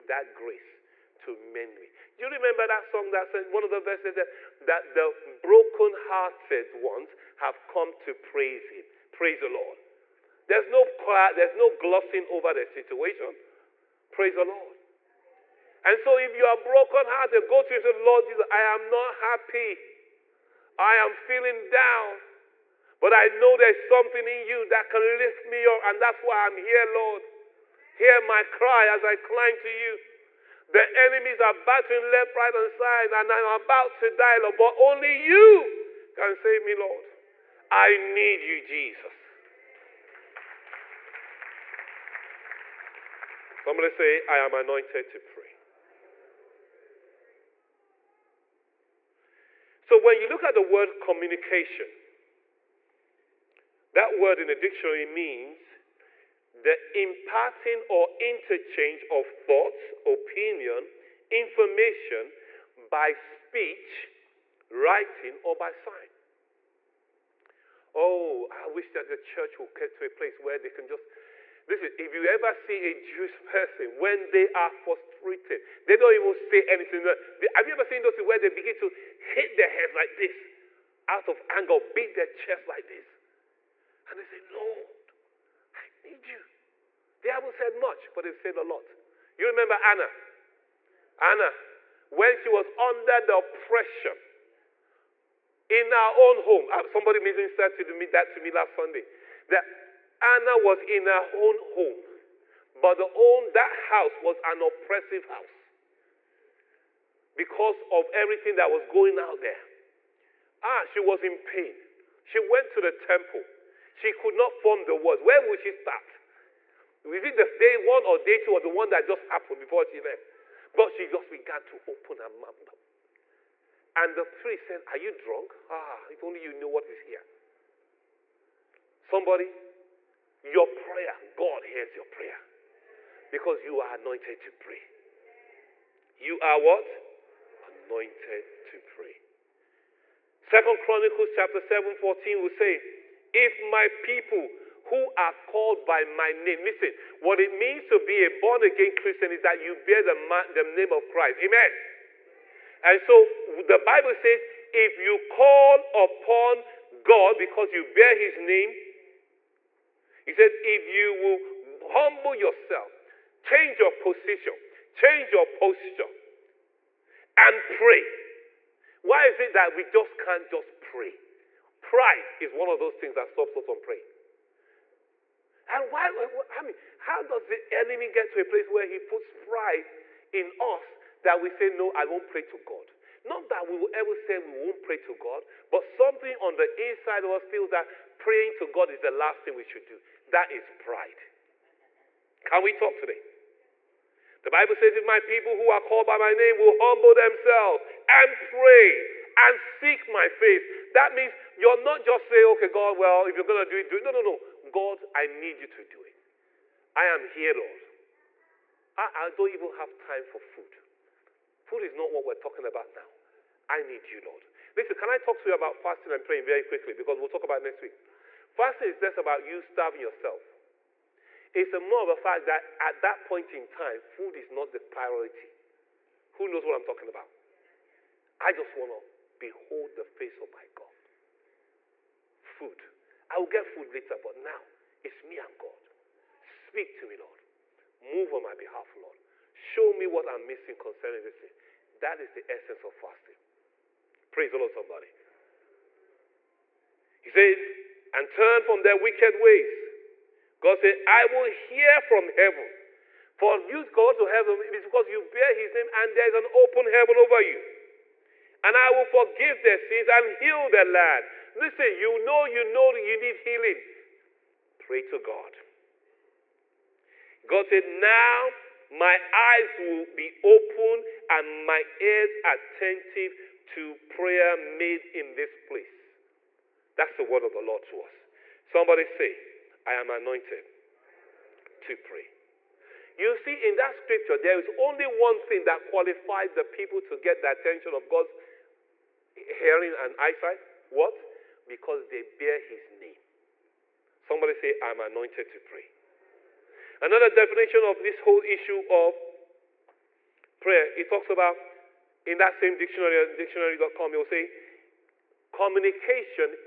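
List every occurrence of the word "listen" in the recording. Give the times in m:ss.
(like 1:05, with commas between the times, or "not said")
1:11, 2:26, 3:34, 4:21.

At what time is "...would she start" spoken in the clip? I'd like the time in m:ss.
1:55.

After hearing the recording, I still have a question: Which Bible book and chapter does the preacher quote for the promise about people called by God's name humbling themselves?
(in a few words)
Second Chronicles 7.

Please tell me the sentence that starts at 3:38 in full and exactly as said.
Fasting is less about you starving yourself.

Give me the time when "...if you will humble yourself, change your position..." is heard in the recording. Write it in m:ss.
2:40.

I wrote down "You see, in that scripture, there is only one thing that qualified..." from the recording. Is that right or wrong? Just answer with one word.
right.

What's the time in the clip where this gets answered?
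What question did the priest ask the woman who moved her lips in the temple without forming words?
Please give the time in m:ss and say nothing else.
2:04.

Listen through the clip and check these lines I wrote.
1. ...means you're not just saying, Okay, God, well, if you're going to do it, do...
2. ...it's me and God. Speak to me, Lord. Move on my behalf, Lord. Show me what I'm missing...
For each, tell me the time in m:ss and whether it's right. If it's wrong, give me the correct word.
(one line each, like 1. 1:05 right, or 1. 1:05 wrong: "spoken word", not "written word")
1. 3:21 right
2. 3:55 right.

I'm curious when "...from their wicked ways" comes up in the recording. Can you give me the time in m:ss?
4:08.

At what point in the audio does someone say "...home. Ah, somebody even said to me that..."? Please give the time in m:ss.
1:36.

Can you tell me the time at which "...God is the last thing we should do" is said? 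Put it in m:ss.
3:08.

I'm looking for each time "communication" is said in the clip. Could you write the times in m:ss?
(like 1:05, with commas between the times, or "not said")
0:50, 5:05.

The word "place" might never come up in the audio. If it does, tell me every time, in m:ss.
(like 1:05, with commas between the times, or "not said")
1:10, 2:58, 4:35.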